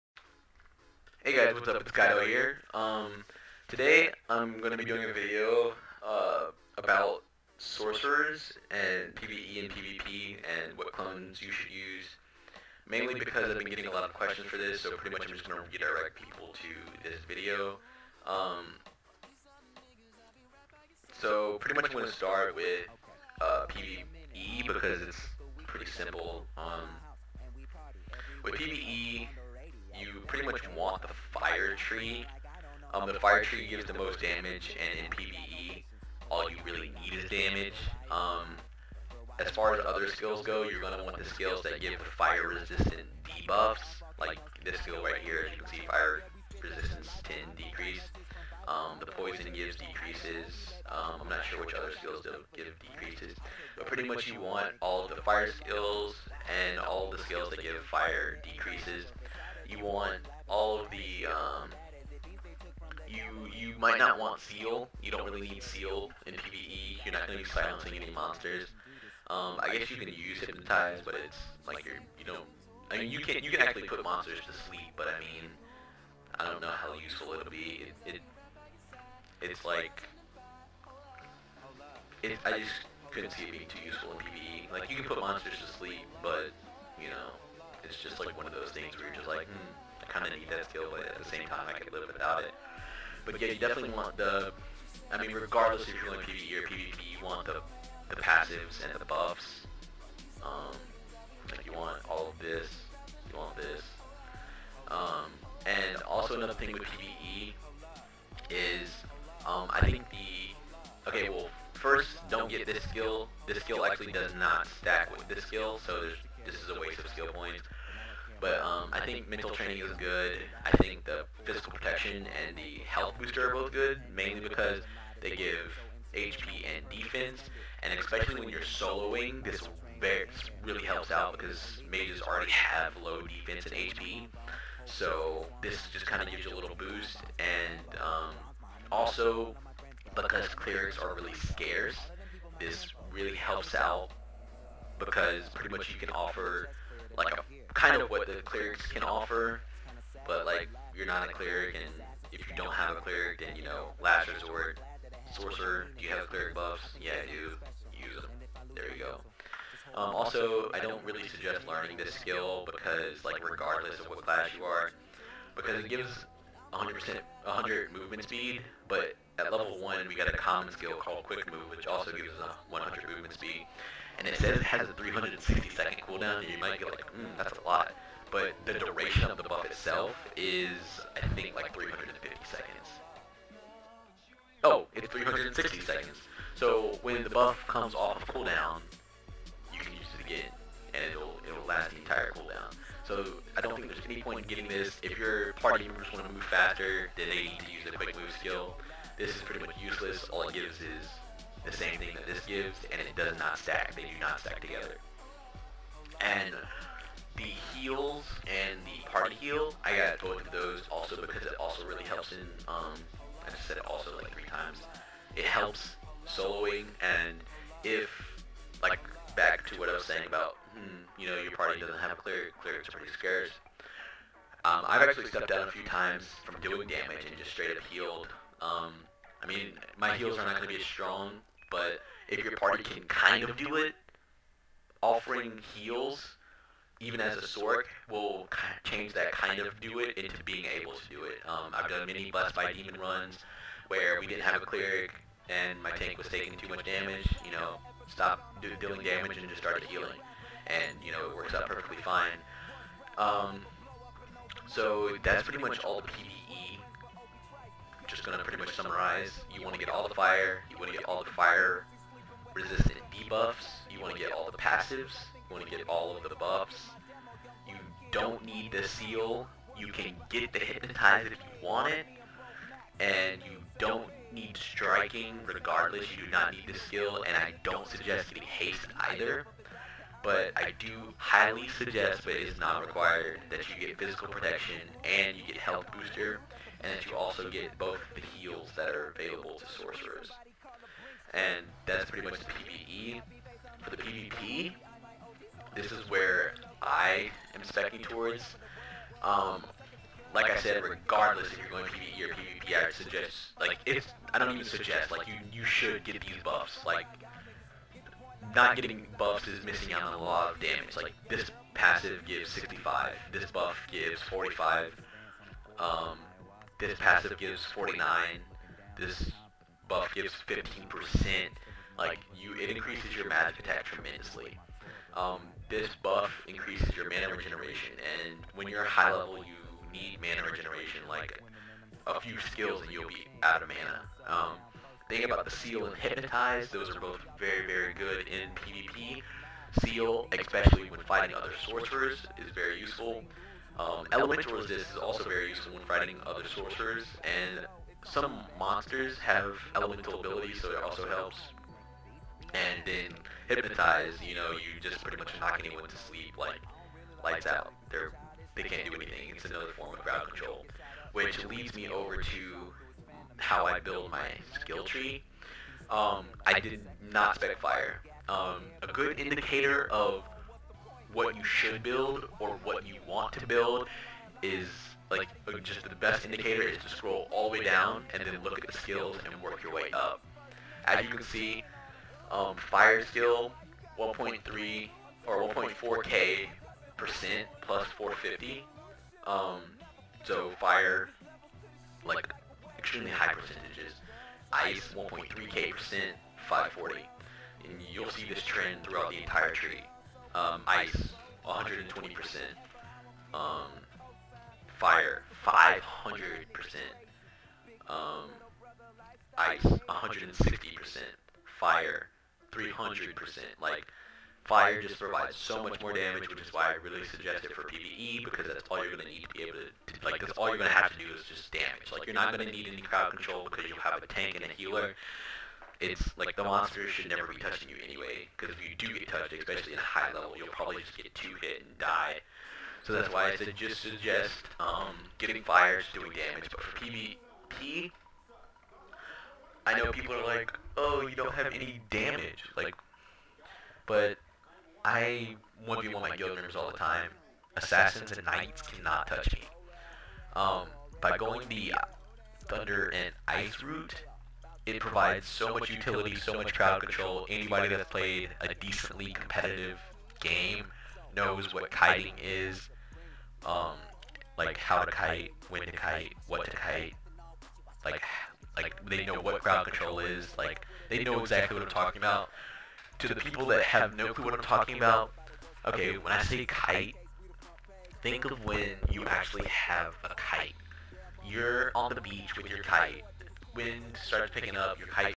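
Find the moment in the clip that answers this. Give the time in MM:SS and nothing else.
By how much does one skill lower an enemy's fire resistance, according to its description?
00:45.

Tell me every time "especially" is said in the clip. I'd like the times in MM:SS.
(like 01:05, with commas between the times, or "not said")
02:07, 05:40, 07:09.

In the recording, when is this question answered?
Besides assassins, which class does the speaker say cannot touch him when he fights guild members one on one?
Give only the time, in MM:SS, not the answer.
07:28.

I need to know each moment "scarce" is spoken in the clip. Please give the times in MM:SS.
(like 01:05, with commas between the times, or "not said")
02:21, 03:43.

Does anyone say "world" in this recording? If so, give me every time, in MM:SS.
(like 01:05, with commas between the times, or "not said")
not said.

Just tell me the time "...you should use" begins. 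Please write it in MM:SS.
00:11.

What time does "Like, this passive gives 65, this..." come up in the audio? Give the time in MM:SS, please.
05:10.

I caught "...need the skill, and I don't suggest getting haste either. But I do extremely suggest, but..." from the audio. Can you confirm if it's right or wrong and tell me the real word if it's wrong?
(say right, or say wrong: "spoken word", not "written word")
wrong: "highly", not "extremely".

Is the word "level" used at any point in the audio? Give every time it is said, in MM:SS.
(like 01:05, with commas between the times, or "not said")
02:49, 05:29, 07:10.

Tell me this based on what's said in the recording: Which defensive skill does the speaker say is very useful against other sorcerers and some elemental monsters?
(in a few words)
Elemental Resist.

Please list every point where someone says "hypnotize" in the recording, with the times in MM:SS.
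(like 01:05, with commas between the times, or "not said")
01:10, 04:30, 05:35, 05:53.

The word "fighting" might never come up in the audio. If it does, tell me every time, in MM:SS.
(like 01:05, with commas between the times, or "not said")
05:41, 05:45.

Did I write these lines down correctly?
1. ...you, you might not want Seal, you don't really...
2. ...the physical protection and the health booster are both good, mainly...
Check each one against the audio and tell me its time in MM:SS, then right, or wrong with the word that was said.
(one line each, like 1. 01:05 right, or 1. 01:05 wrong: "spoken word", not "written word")
1. 01:03 right
2. 02:01 right.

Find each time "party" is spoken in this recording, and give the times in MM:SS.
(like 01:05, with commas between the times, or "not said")
03:15, 03:29, 03:41, 03:52.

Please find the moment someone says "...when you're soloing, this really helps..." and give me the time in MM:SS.
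02:08.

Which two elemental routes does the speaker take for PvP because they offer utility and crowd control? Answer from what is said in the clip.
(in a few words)
Thunder and ice.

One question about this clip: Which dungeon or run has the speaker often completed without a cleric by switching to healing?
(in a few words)
Blessed by Demon.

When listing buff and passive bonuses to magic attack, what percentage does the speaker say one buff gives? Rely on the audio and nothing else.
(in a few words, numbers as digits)
15%.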